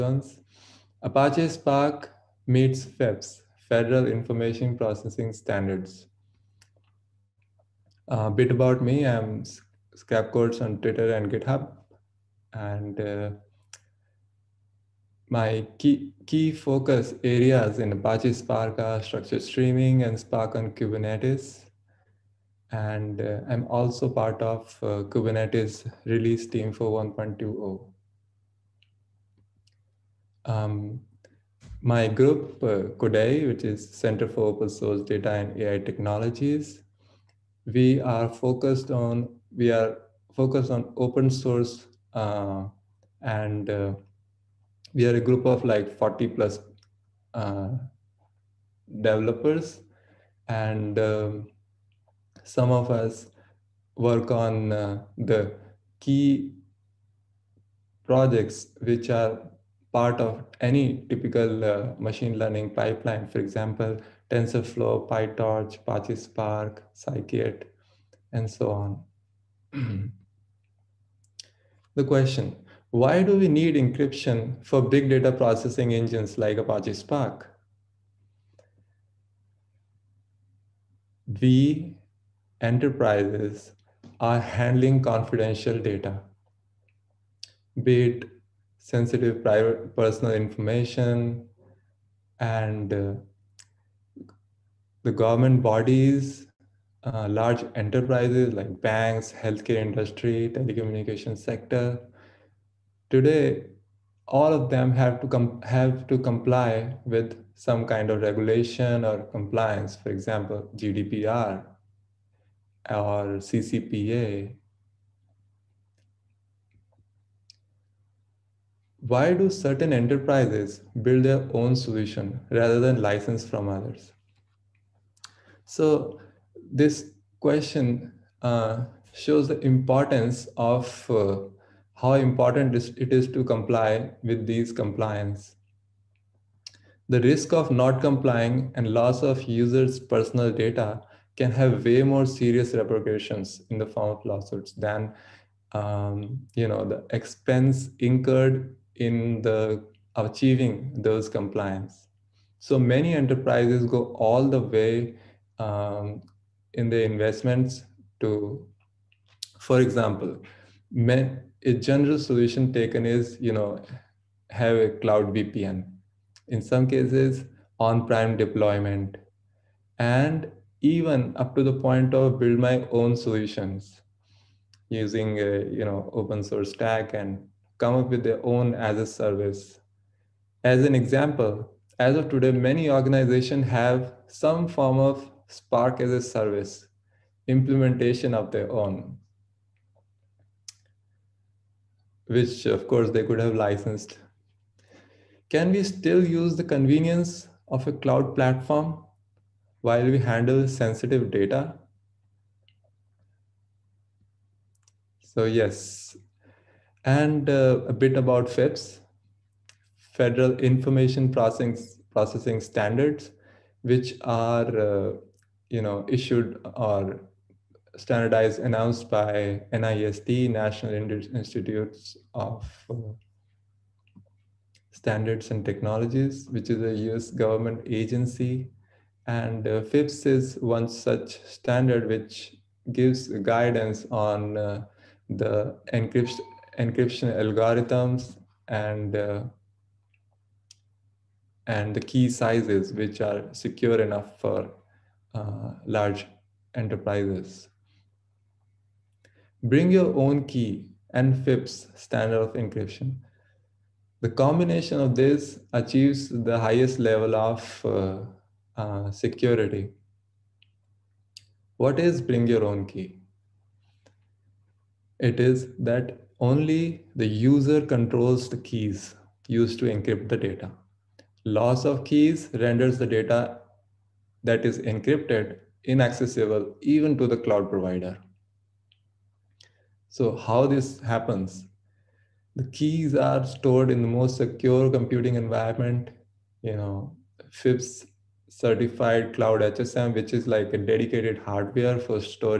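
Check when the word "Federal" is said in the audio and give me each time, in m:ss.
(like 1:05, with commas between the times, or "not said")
0:03, 3:30.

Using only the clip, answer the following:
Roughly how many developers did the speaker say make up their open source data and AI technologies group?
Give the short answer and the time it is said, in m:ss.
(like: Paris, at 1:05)
40 plus, at 0:45.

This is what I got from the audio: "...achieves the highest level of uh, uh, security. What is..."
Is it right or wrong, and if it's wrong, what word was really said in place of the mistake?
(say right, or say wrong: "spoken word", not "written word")
right.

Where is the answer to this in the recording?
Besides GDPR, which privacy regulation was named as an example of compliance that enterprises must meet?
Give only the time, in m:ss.
1:53.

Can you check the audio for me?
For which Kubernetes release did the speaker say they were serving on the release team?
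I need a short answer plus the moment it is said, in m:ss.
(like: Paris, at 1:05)
1.20, at 0:27.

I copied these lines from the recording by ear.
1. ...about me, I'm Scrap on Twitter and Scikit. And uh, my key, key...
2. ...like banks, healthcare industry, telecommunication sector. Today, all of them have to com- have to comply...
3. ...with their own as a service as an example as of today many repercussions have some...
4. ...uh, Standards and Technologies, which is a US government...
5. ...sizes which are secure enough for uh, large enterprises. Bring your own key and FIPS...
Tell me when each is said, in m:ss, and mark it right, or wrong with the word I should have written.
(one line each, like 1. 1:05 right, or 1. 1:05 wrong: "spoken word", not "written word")
1. 0:08 wrong: "GitHub", not "Scikit"
2. 1:38 right
3. 2:58 wrong: "organizations", not "repercussions"
4. 3:42 right
5. 4:02 right.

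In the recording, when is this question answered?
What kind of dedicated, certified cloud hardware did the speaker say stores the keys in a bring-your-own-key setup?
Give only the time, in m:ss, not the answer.
4:49.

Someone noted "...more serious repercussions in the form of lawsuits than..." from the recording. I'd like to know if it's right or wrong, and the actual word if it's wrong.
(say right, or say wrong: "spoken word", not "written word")
right.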